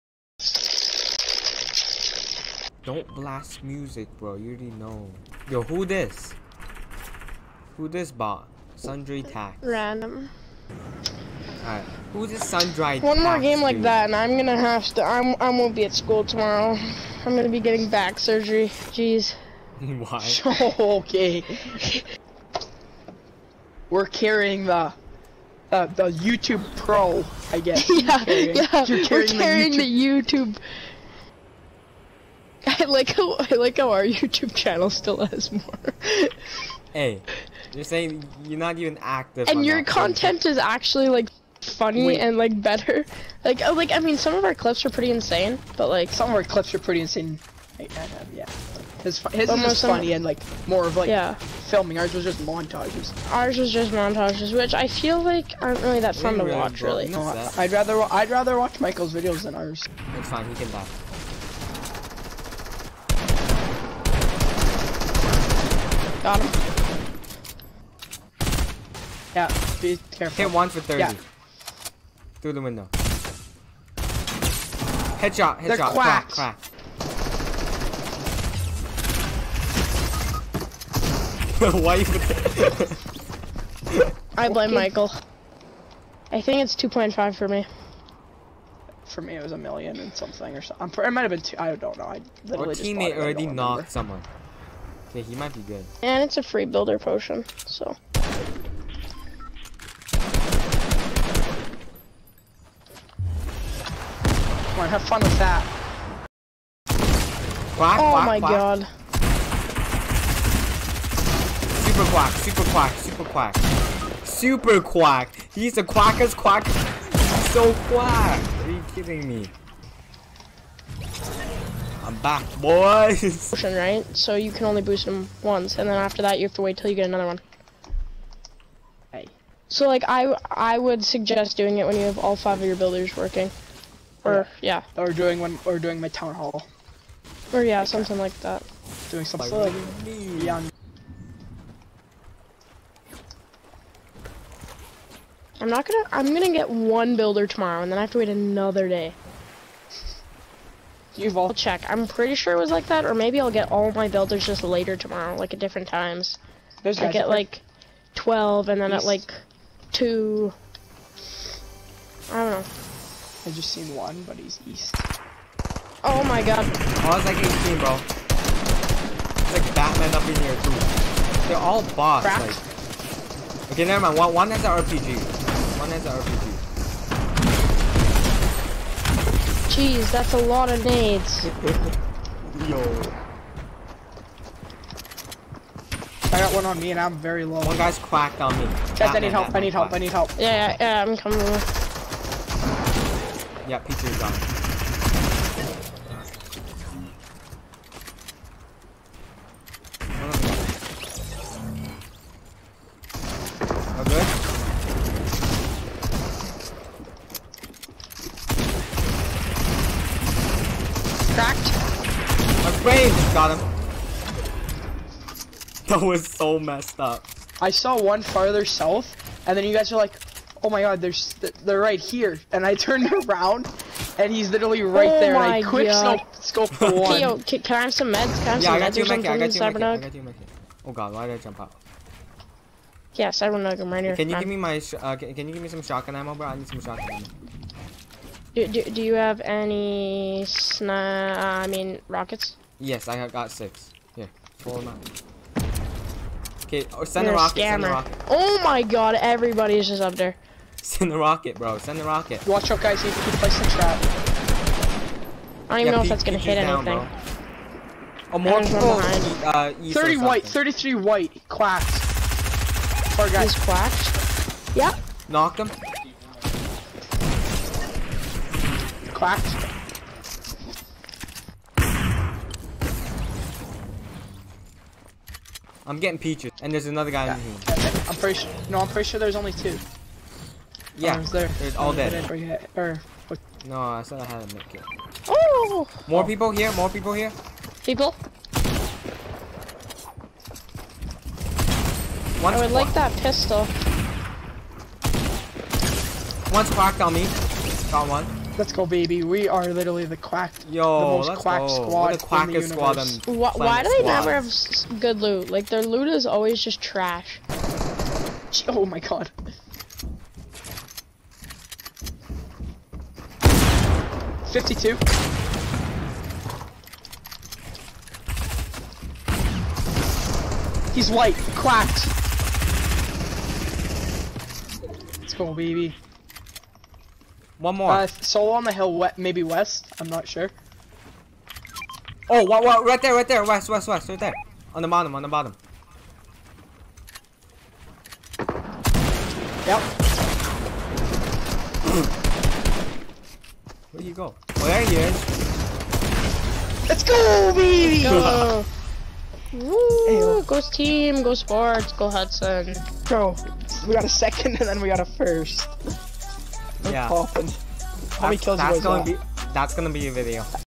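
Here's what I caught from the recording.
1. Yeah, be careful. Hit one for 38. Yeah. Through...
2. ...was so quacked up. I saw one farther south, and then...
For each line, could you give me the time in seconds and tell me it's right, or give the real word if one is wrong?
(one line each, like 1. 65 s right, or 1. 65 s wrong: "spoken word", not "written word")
1. 69 s wrong: "30", not "38"
2. 216 s wrong: "messed", not "quacked".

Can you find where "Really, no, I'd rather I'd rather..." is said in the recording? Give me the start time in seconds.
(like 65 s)
56 s.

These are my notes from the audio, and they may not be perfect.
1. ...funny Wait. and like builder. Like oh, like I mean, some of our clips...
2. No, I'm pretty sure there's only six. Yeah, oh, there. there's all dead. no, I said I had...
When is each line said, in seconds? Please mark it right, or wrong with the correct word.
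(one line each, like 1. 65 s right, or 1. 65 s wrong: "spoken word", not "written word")
1. 41 s wrong: "better", not "builder"
2. 278 s wrong: "two", not "six".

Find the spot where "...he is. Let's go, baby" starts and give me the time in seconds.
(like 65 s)
344 s.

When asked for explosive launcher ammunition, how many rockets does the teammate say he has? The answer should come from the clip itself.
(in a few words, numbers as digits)
6.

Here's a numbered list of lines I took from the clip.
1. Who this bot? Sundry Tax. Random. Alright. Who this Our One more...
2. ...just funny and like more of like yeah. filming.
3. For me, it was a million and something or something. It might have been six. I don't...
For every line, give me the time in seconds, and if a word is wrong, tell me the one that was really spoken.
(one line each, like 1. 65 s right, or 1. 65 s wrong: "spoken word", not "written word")
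1. 7 s wrong: "Sundry", not "Our"
2. 49 s right
3. 89 s wrong: "two", not "six".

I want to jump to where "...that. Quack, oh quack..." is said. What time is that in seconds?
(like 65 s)
105 s.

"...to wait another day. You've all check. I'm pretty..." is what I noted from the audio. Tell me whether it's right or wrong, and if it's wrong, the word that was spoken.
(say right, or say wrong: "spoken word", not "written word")
right.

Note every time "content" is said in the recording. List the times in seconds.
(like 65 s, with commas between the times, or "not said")
39 s.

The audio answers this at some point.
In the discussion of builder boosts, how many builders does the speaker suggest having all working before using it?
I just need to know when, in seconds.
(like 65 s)
132 s.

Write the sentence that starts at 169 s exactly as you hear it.
It's like Batman up in here, too.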